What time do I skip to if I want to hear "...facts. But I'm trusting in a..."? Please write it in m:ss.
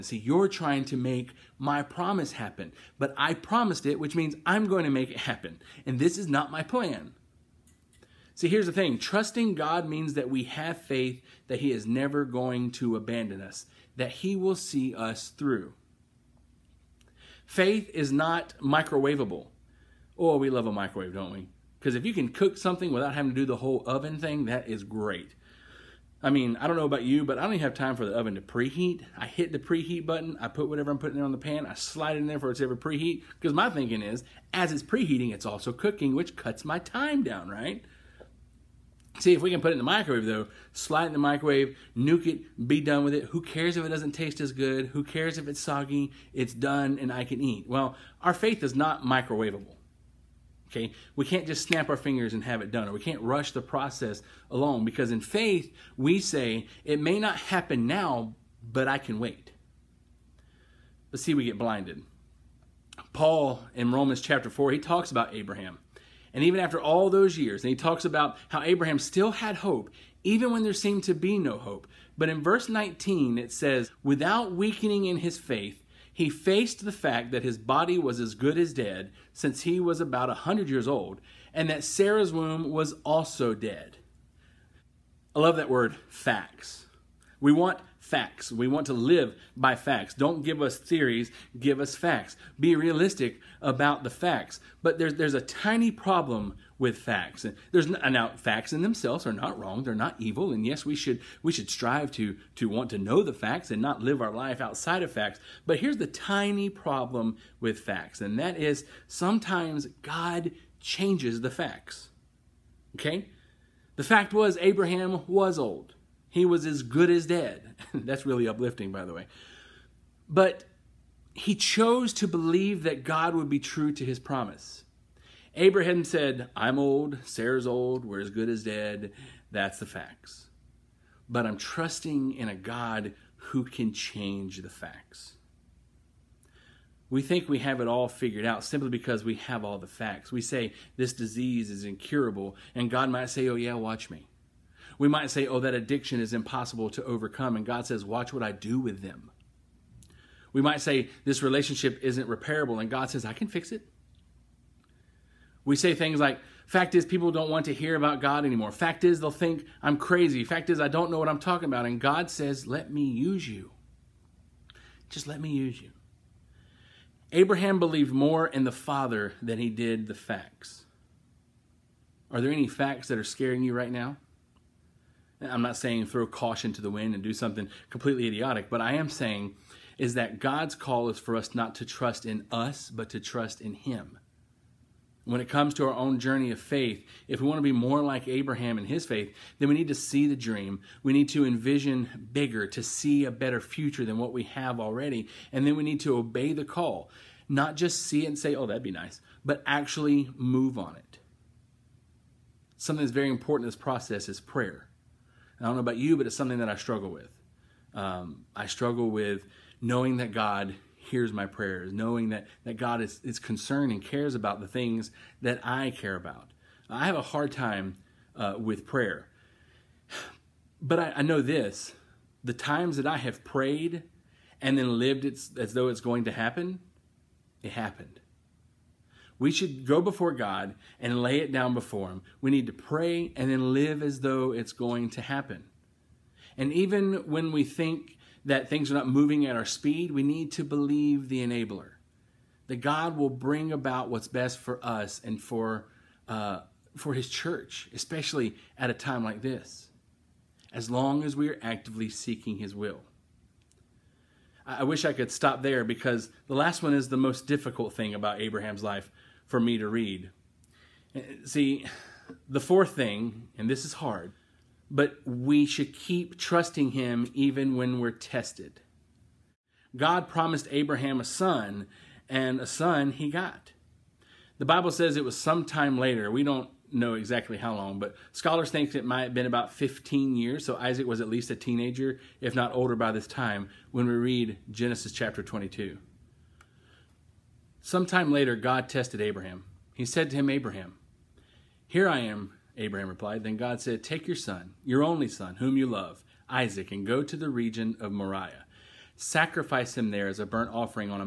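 2:09.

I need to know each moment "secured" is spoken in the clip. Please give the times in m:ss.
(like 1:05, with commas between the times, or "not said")
not said.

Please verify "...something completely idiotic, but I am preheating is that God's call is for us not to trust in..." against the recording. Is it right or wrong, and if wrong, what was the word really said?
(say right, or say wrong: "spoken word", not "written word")
wrong: "saying", not "preheating".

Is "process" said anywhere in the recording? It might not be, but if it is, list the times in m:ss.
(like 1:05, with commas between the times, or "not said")
0:53, 3:23.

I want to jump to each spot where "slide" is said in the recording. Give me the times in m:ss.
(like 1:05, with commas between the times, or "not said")
0:31, 0:40.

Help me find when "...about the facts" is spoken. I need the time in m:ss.
1:33.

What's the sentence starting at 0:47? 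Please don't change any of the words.
Well, our faith is not microwavable.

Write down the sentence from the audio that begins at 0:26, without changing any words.
I mean, I don't know about you, but I don't even have time for the oven to preheat.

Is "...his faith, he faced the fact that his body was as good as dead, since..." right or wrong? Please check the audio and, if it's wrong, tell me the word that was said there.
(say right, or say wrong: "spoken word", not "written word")
right.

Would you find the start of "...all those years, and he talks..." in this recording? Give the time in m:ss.
1:06.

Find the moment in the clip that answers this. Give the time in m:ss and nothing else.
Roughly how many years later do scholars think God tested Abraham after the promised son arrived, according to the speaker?
4:39.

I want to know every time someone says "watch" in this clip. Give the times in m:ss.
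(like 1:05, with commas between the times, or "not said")
2:23, 2:28.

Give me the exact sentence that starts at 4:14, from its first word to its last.
I wish I could stop there because the last one is the most difficult thing about Abraham's life for me to read.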